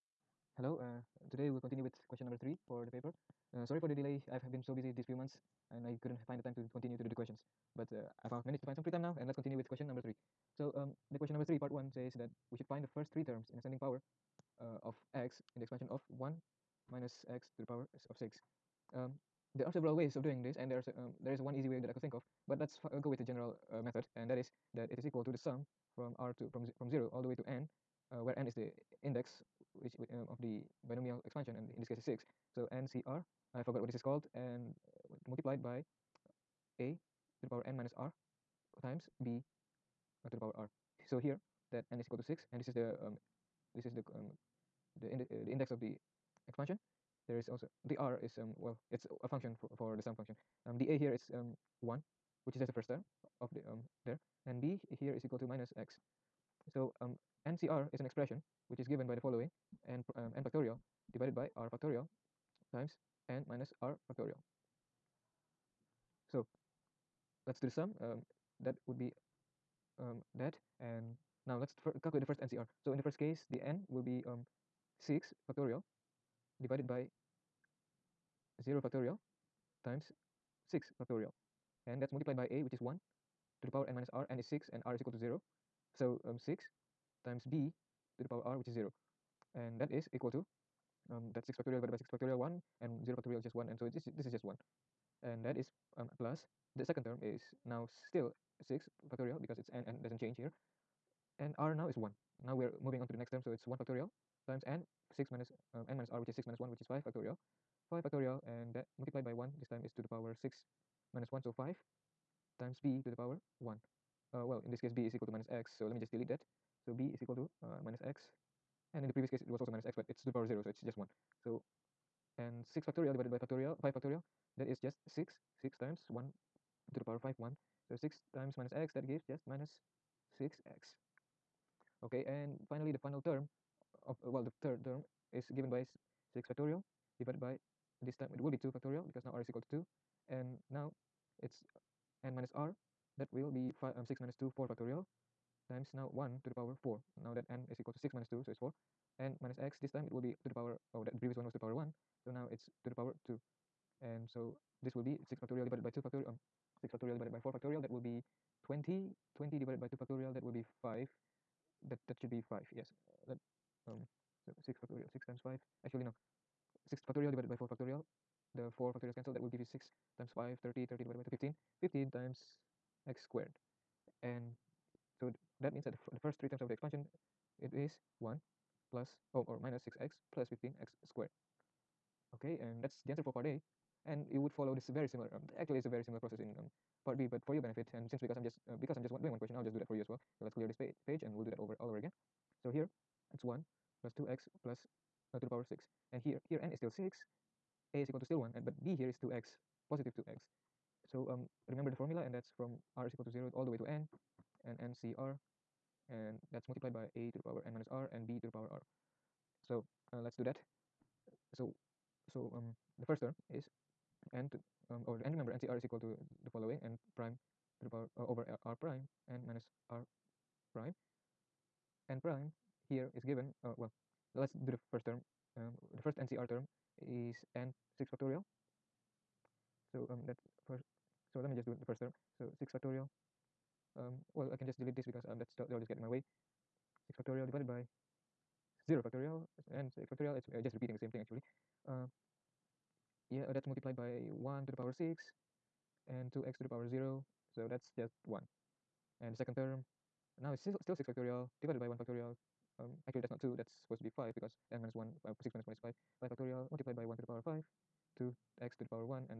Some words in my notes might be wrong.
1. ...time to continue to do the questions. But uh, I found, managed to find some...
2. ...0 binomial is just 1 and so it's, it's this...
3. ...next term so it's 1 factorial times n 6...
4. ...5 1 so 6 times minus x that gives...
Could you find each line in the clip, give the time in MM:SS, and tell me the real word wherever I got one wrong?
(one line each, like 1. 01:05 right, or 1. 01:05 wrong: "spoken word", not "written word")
1. 00:06 right
2. 01:33 wrong: "factorial", not "binomial"
3. 01:43 right
4. 02:07 right.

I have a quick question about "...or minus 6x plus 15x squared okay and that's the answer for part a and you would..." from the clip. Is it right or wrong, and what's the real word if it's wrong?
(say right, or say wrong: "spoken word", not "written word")
right.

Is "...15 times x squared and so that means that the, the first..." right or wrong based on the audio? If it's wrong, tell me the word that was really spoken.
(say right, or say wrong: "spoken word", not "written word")
right.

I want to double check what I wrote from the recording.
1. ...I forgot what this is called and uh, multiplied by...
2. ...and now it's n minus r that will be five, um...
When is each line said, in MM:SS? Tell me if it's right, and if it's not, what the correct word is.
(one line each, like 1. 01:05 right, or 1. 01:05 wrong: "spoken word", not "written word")
1. 00:33 right
2. 02:20 right.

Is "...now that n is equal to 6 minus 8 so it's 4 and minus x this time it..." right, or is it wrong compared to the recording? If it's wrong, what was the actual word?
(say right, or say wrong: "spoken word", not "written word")
wrong: "2", not "8".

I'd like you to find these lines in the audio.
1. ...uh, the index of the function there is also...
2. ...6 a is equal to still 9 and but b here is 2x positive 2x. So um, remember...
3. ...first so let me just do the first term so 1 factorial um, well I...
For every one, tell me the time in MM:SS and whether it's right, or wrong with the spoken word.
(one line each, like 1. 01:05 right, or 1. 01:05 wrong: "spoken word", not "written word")
1. 00:45 wrong: "expansion", not "function"
2. 03:16 wrong: "1", not "9"
3. 03:50 wrong: "6", not "1".